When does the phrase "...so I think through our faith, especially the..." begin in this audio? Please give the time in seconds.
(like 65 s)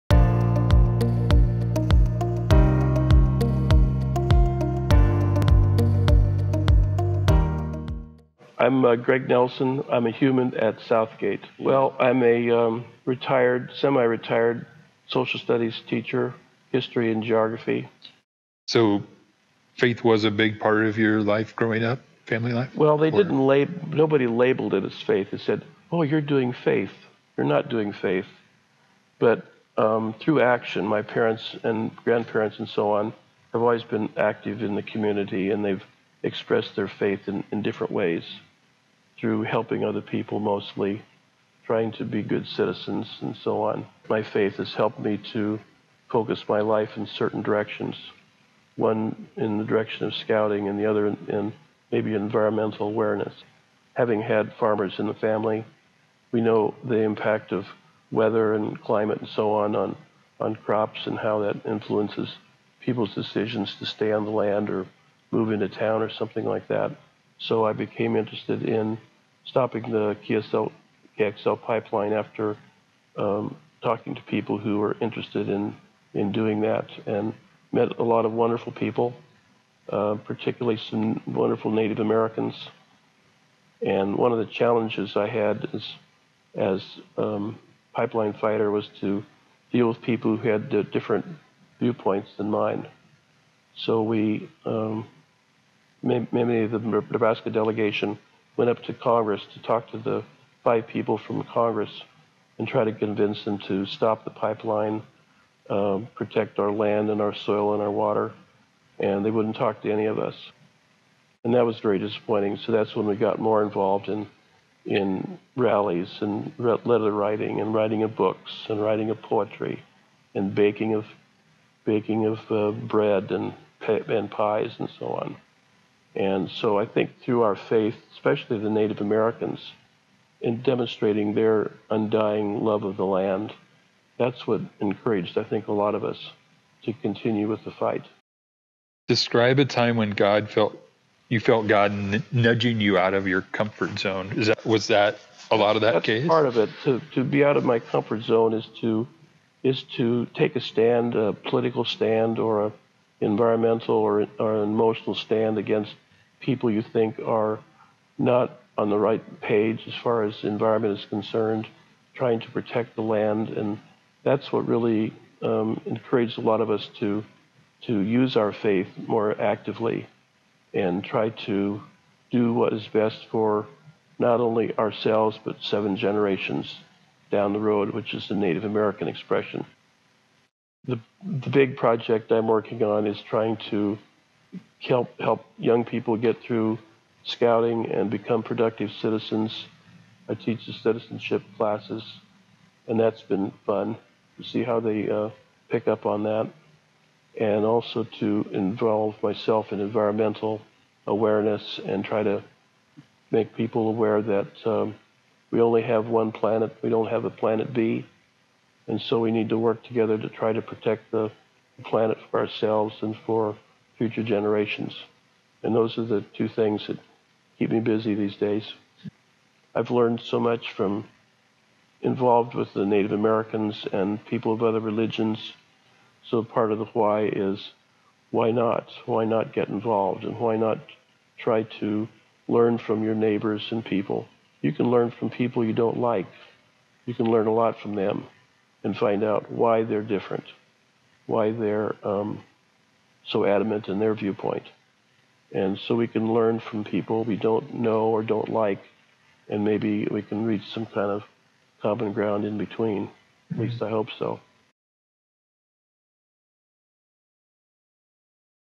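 126 s.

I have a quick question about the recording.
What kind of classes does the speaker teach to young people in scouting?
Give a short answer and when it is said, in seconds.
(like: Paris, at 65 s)
citizenship classes, at 190 s.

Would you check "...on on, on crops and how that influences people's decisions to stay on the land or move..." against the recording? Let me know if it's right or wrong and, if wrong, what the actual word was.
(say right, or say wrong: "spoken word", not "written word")
right.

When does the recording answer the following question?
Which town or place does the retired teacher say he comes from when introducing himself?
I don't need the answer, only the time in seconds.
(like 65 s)
10 s.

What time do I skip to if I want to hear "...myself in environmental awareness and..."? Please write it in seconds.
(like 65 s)
199 s.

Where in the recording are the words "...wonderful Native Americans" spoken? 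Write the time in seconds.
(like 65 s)
81 s.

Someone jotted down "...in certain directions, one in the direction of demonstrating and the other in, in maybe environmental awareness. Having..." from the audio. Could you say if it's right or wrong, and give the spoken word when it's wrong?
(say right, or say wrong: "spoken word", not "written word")
wrong: "scouting", not "demonstrating".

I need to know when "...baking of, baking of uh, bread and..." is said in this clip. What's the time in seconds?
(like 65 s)
120 s.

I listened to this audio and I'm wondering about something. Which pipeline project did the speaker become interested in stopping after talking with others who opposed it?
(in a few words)
KXL pipeline.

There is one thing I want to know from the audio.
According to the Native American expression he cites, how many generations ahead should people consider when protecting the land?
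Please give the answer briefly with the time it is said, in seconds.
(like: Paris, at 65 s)
7, at 175 s.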